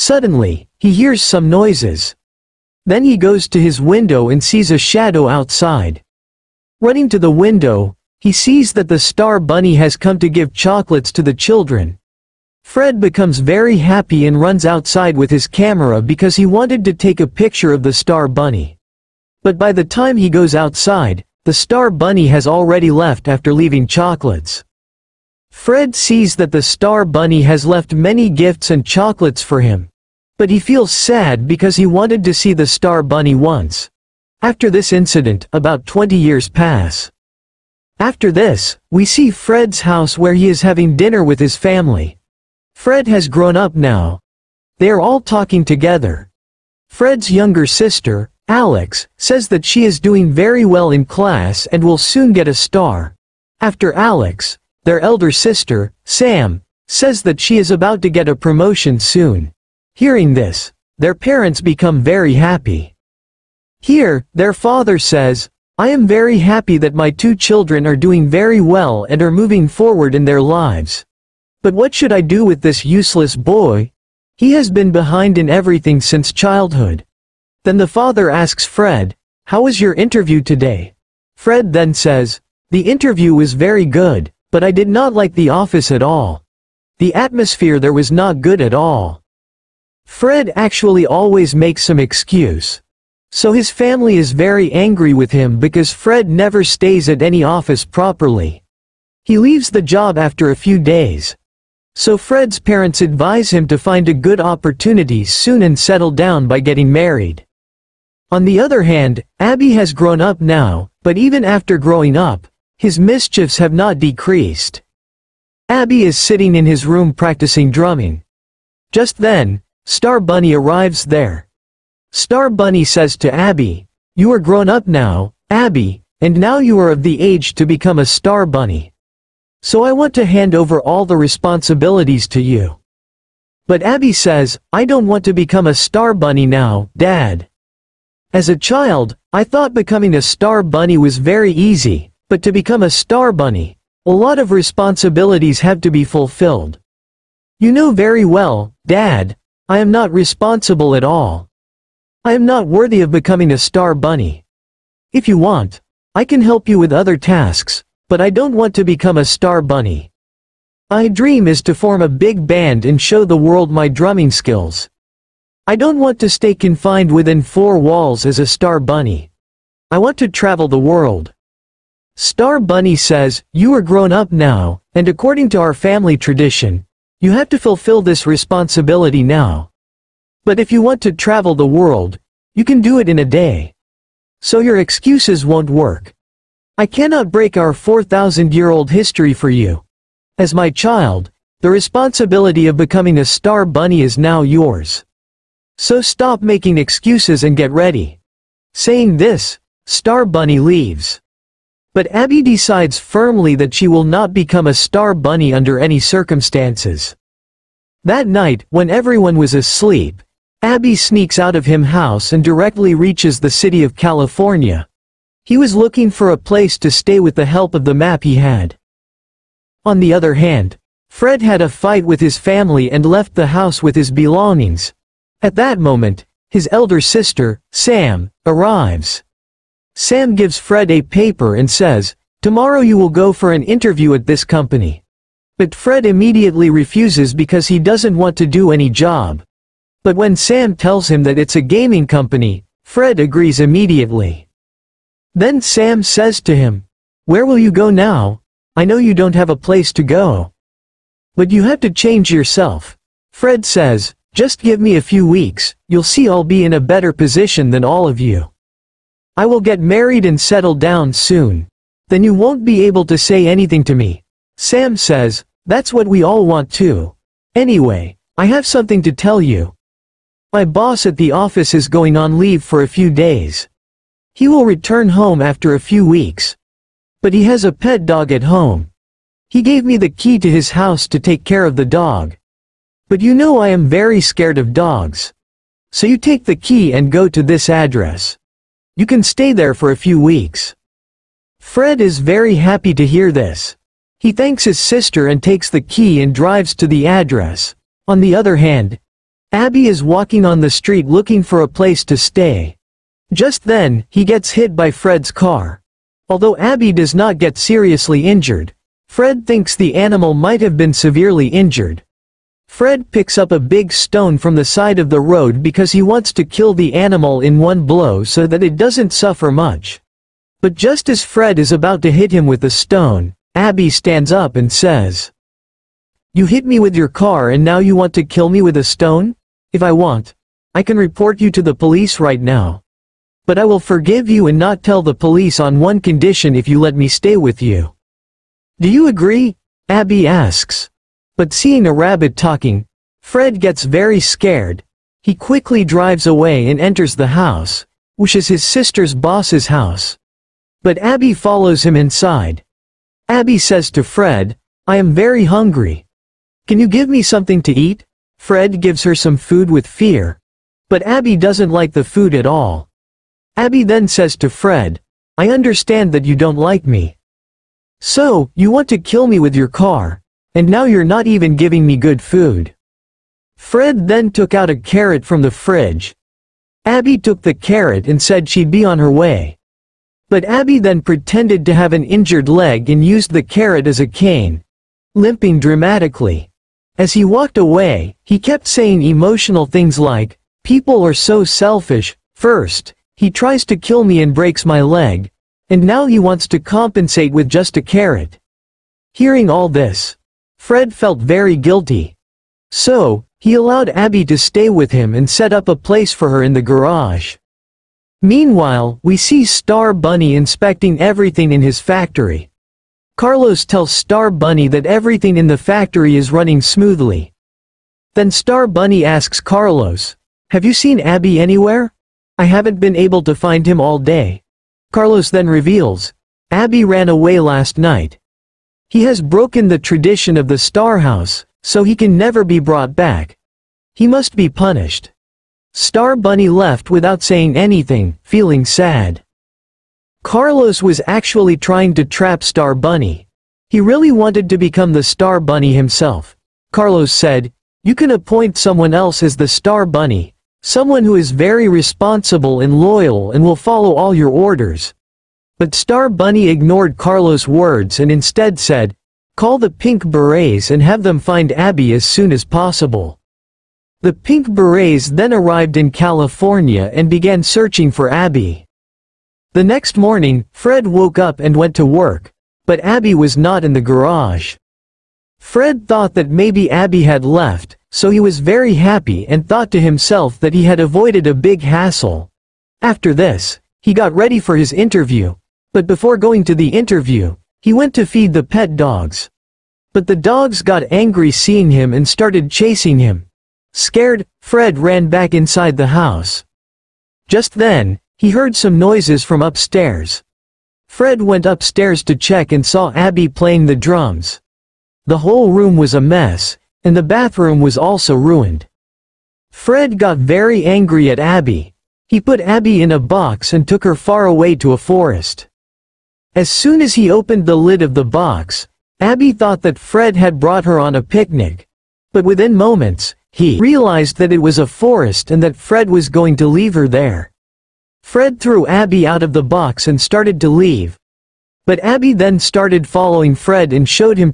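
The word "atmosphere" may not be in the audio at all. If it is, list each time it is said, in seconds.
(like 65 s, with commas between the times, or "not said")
87 s.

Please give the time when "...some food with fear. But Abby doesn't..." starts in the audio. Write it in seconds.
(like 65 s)
359 s.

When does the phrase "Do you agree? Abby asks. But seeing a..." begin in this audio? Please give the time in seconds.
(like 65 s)
338 s.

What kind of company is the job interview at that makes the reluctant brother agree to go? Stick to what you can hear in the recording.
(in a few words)
A gaming company.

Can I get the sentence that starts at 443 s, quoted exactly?
He really wanted to become the Star Bunny himself.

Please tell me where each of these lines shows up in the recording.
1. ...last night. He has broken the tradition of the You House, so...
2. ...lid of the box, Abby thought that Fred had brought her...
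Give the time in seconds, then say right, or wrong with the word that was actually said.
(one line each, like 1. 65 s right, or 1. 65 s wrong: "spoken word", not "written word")
1. 427 s wrong: "Star", not "You"
2. 517 s right.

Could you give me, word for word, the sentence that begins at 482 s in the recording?
After this, he got ready for his interview, but before going to the interview, he went to feed the pet dogs.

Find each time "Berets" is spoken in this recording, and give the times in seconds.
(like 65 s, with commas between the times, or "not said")
460 s, 464 s.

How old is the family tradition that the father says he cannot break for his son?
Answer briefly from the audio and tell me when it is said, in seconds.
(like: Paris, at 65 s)
4,000 years, at 187 s.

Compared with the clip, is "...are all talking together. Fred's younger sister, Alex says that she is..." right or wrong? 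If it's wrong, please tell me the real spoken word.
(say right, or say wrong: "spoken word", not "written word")
right.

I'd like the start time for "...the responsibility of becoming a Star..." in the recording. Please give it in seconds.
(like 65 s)
191 s.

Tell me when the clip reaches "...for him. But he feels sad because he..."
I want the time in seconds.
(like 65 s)
29 s.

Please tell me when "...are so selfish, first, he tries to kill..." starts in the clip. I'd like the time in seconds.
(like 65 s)
391 s.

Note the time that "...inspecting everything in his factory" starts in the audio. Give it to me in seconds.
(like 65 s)
410 s.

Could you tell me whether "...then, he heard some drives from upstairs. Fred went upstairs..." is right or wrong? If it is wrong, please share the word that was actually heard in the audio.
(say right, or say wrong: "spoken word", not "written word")
wrong: "noises", not "drives".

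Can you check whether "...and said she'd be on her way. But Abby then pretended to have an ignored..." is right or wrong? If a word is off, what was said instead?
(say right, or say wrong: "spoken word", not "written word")
wrong: "injured", not "ignored".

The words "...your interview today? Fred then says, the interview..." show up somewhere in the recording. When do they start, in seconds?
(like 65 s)
79 s.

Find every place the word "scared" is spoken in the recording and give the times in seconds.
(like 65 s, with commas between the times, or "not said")
284 s, 344 s, 493 s.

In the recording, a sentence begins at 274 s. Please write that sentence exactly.
He will return home after a few weeks.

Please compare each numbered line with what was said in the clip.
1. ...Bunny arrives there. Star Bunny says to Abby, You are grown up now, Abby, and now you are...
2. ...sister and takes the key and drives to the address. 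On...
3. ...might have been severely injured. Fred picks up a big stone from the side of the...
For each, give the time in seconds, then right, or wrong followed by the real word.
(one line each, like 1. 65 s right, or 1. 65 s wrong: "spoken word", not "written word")
1. 120 s right
2. 294 s right
3. 310 s right.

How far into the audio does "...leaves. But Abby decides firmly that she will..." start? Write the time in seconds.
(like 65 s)
200 s.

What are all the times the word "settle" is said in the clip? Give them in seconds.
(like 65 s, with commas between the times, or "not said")
105 s, 260 s.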